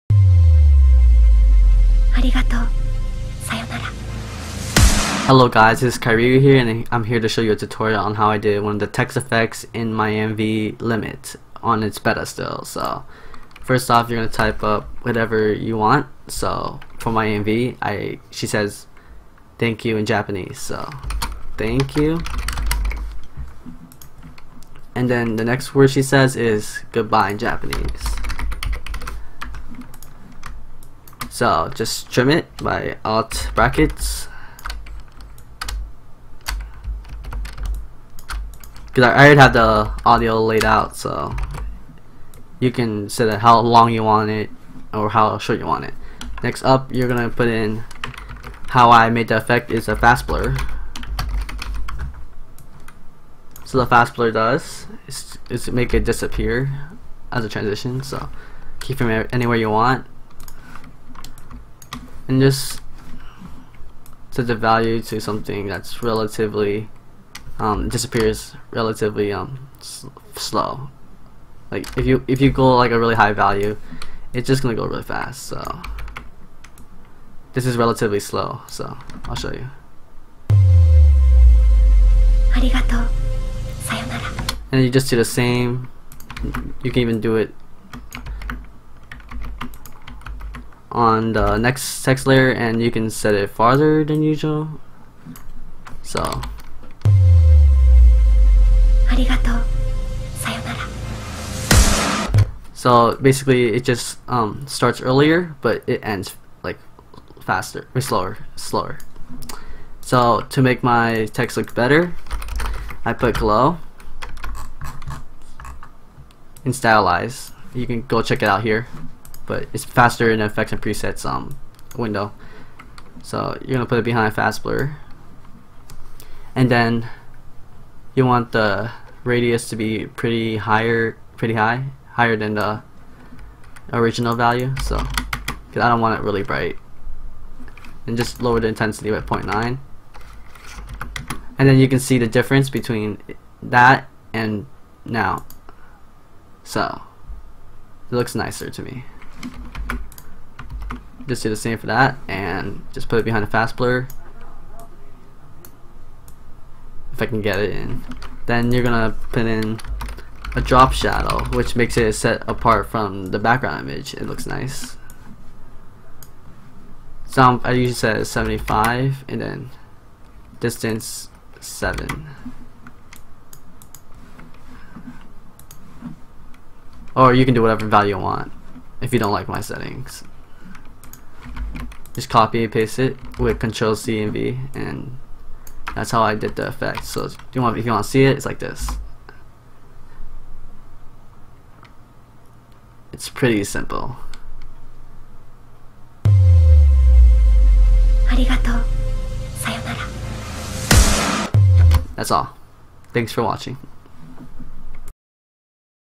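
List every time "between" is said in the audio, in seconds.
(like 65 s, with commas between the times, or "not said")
142 s.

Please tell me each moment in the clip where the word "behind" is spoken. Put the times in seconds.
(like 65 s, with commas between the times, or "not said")
124 s, 153 s.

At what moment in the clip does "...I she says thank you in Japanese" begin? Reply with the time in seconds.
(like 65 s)
17 s.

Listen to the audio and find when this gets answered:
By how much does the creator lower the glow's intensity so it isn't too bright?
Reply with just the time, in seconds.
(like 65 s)
139 s.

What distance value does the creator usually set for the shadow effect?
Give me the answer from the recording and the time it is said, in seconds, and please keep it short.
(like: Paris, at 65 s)
7, at 170 s.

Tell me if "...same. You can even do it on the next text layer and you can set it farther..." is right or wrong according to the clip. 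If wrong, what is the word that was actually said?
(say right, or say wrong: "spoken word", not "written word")
right.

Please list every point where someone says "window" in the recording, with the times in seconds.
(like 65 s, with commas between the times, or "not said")
121 s.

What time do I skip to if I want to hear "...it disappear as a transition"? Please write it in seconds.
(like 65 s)
55 s.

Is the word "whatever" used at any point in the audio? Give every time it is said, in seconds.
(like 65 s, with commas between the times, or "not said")
15 s, 177 s.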